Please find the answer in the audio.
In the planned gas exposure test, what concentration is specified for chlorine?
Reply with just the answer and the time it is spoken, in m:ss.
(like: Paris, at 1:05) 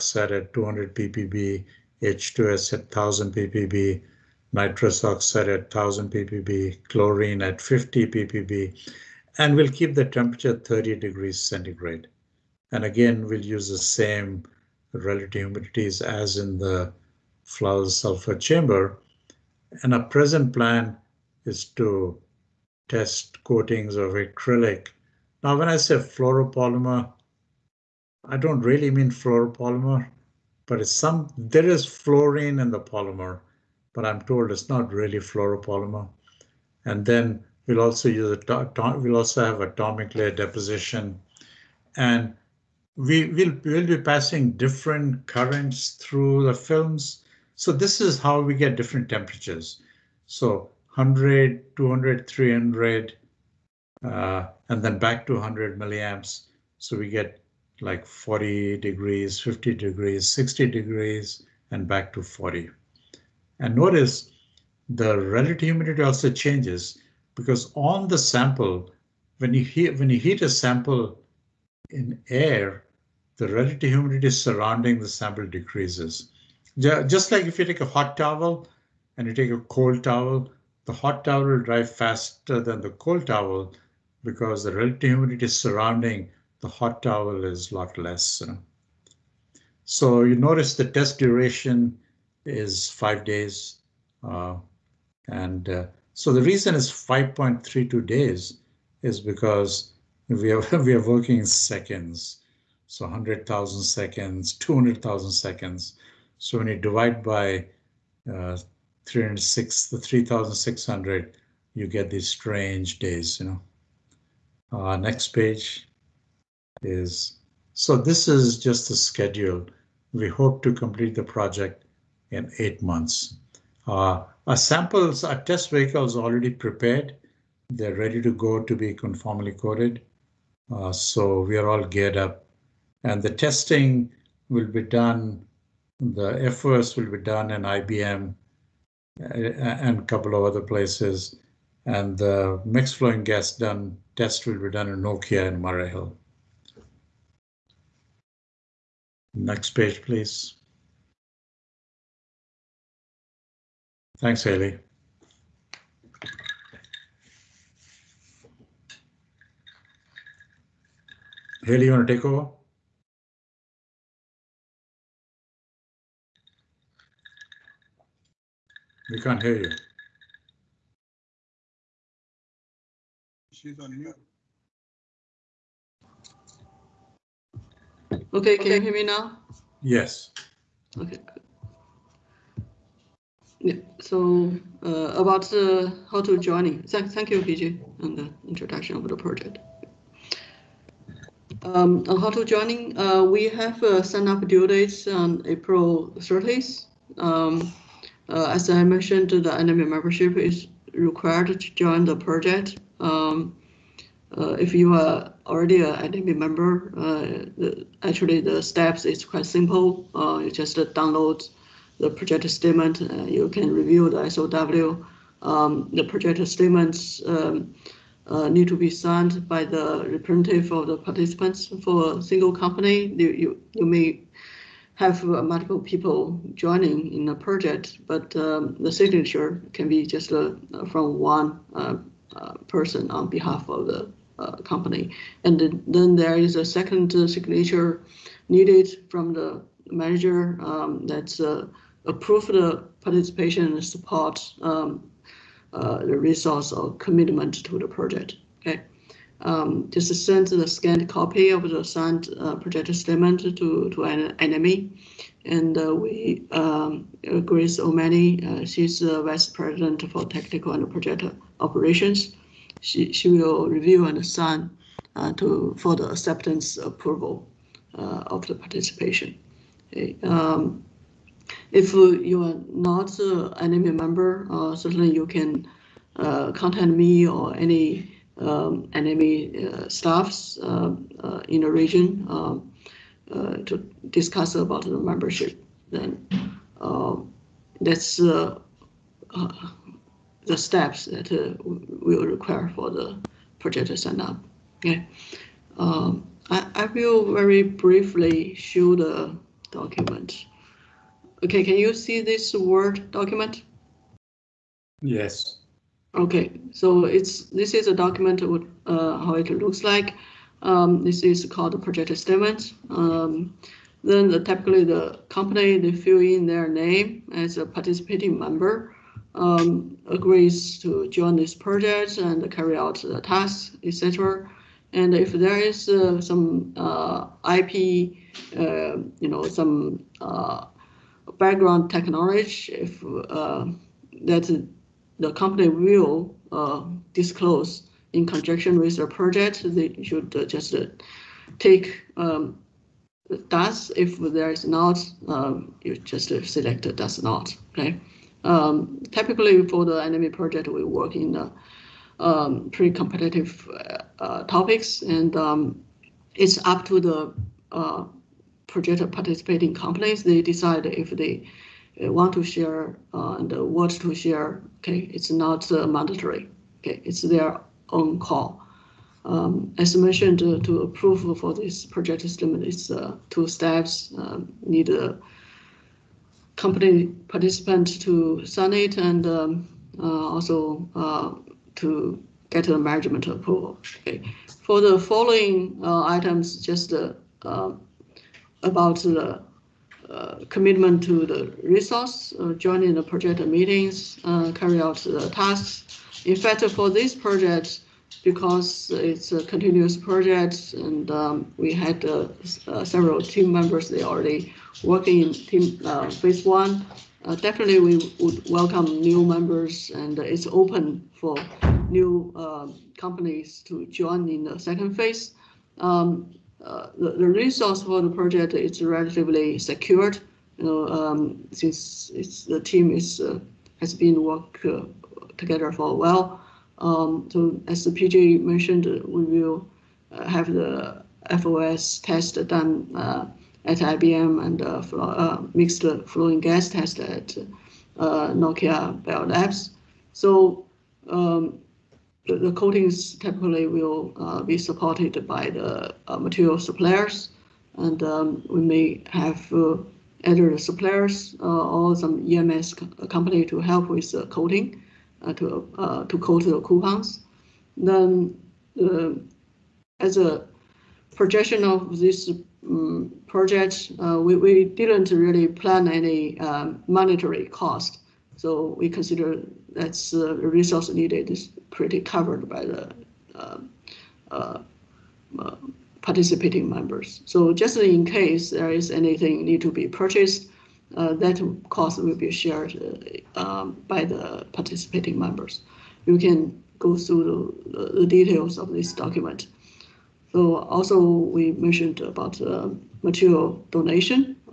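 50 ppb, at 0:06.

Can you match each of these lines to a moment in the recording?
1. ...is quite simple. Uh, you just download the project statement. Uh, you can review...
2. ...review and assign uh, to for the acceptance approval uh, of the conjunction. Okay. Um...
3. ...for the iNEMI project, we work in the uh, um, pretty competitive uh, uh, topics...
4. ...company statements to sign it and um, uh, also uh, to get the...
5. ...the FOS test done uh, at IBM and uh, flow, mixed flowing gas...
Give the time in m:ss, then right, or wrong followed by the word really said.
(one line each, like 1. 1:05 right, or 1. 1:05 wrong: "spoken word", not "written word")
1. 3:29 right
2. 4:23 wrong: "participation", not "conjunction"
3. 5:49 right
4. 6:16 wrong: "participants", not "statements"
5. 7:10 right.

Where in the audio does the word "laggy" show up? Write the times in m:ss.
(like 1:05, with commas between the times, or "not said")
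not said.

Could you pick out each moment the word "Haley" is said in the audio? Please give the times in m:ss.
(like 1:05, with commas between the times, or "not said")
2:34, 2:41.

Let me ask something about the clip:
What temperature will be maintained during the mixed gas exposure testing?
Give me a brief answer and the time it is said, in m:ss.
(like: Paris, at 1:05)
30 degrees centigrade, at 0:10.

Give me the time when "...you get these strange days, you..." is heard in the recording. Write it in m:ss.
1:51.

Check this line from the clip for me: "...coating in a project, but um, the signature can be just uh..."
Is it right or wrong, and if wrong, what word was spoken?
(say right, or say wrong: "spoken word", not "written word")
wrong: "joining", not "coating".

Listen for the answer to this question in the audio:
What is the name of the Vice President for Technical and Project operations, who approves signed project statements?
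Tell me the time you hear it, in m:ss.
4:17.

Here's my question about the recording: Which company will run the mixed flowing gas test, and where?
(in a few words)
Nokia in Murray Hill.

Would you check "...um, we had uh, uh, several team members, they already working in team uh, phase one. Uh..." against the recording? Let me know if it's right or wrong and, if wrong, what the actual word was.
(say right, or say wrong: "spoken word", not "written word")
right.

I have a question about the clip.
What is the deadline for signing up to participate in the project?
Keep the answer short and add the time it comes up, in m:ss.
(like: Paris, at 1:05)
April 30, at 3:15.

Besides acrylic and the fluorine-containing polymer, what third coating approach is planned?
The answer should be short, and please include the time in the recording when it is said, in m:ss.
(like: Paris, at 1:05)
Atomic layer deposition, at 0:39.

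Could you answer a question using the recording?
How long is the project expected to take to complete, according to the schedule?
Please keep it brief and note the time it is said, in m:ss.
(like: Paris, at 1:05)
8 months, at 2:02.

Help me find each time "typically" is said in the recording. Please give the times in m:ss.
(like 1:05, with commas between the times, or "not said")
5:14, 5:49, 7:23.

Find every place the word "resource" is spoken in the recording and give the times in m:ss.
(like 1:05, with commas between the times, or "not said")
4:06, 6:31, 6:57, 7:50.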